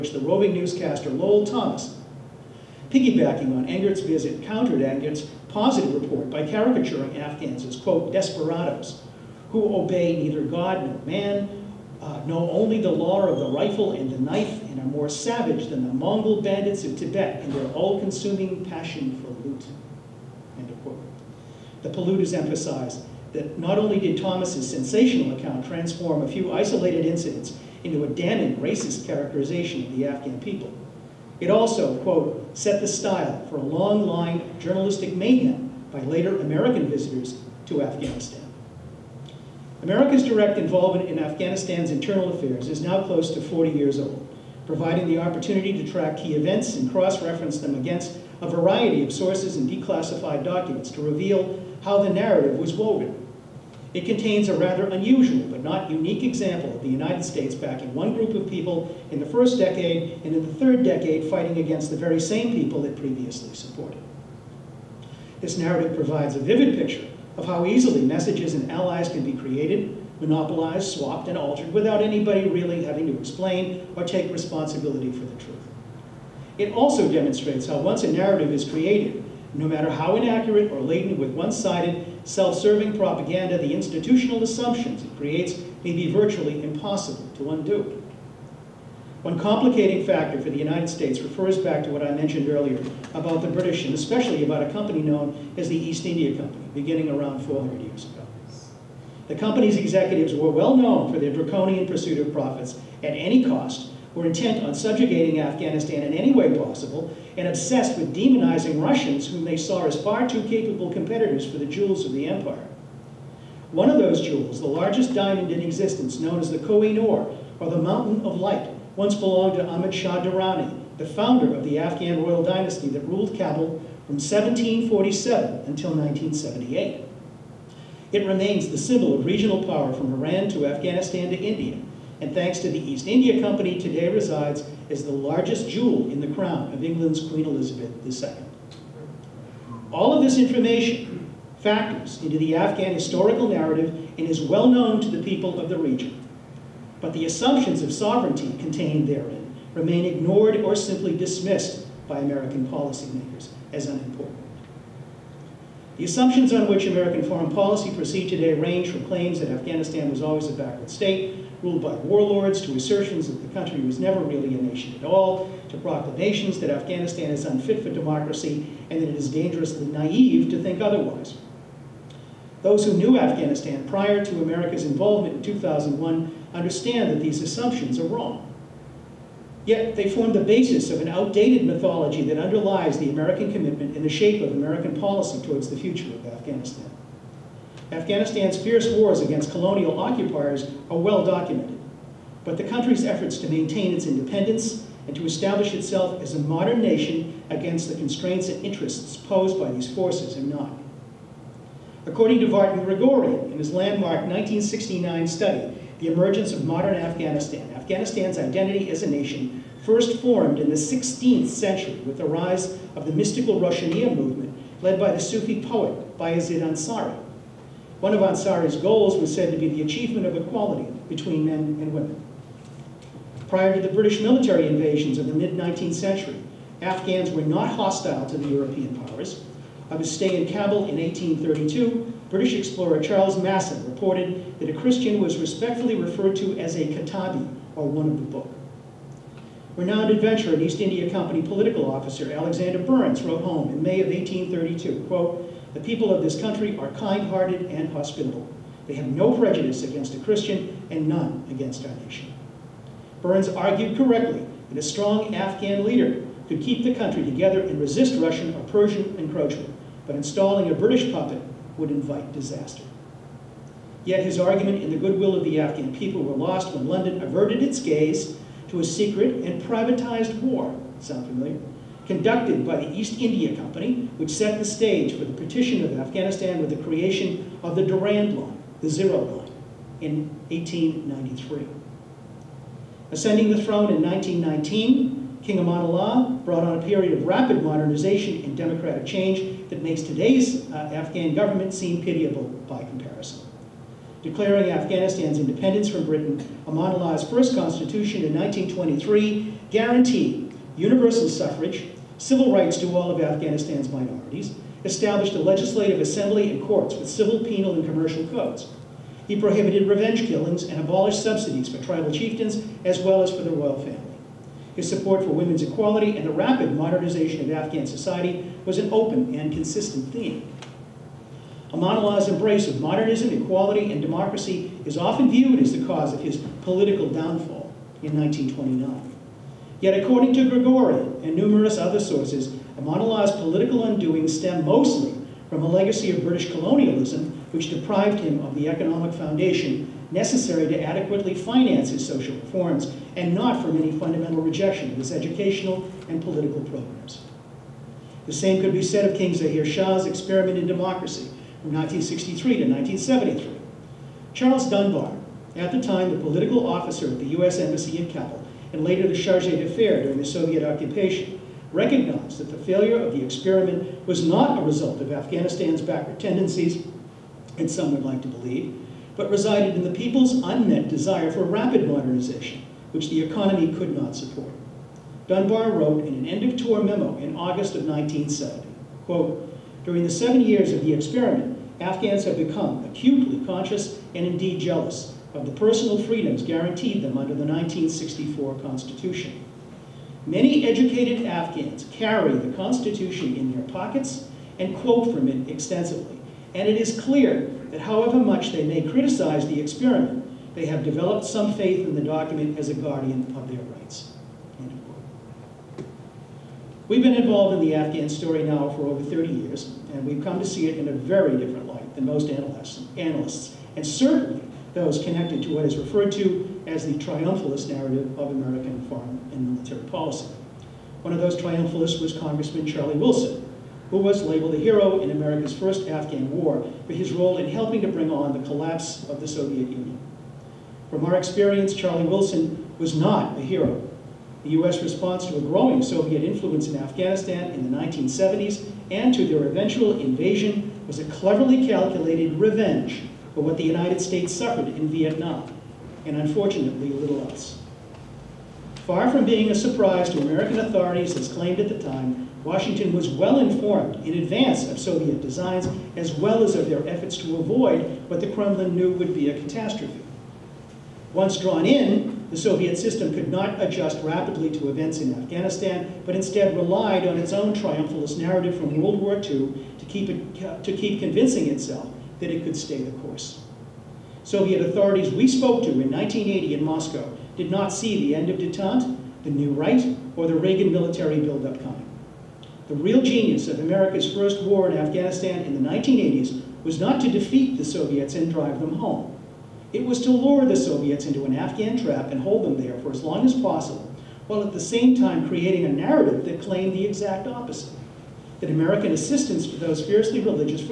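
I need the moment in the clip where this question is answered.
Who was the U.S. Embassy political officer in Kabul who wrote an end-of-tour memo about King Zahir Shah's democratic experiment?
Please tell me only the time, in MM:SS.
05:54.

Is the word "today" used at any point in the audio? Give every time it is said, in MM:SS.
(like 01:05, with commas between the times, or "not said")
02:13, 02:38, 04:50.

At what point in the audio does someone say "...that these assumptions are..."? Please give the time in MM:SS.
02:57.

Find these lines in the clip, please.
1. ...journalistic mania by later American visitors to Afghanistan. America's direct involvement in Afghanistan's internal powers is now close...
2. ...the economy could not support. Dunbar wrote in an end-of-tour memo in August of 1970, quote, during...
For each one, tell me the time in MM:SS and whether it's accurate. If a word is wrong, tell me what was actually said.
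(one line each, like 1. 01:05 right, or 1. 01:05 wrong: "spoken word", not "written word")
1. 00:34 wrong: "affairs", not "powers"
2. 06:13 right.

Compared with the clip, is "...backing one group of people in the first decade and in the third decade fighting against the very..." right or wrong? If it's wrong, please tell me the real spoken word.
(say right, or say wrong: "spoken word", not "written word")
right.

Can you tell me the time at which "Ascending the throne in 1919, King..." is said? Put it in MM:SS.
04:43.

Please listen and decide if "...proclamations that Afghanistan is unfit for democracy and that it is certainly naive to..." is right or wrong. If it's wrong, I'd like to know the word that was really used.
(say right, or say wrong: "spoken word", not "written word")
wrong: "dangerously", not "certainly".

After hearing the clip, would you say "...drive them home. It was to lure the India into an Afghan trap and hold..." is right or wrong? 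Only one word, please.
wrong.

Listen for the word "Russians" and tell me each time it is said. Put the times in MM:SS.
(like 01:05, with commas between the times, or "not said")
01:48, 04:18.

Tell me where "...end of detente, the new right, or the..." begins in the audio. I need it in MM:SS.
07:58.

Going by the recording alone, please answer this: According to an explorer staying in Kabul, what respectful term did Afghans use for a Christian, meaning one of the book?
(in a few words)
Katabi.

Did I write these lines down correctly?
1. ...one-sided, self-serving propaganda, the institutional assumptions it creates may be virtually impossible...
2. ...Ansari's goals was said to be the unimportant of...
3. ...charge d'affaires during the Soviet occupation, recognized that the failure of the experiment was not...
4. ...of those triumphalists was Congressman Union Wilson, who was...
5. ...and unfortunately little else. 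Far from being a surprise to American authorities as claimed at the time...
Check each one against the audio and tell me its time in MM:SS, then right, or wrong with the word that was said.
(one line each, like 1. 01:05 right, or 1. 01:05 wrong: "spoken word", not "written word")
1. 01:21 right
2. 03:38 wrong: "achievement", not "unimportant"
3. 05:59 right
4. 07:01 wrong: "Charlie", not "Union"
5. 07:26 right.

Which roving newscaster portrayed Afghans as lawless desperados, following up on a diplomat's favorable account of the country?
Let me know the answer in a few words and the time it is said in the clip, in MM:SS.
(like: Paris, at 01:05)
Lowell Thomas, at 00:01.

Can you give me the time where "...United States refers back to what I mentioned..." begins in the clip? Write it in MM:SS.
01:30.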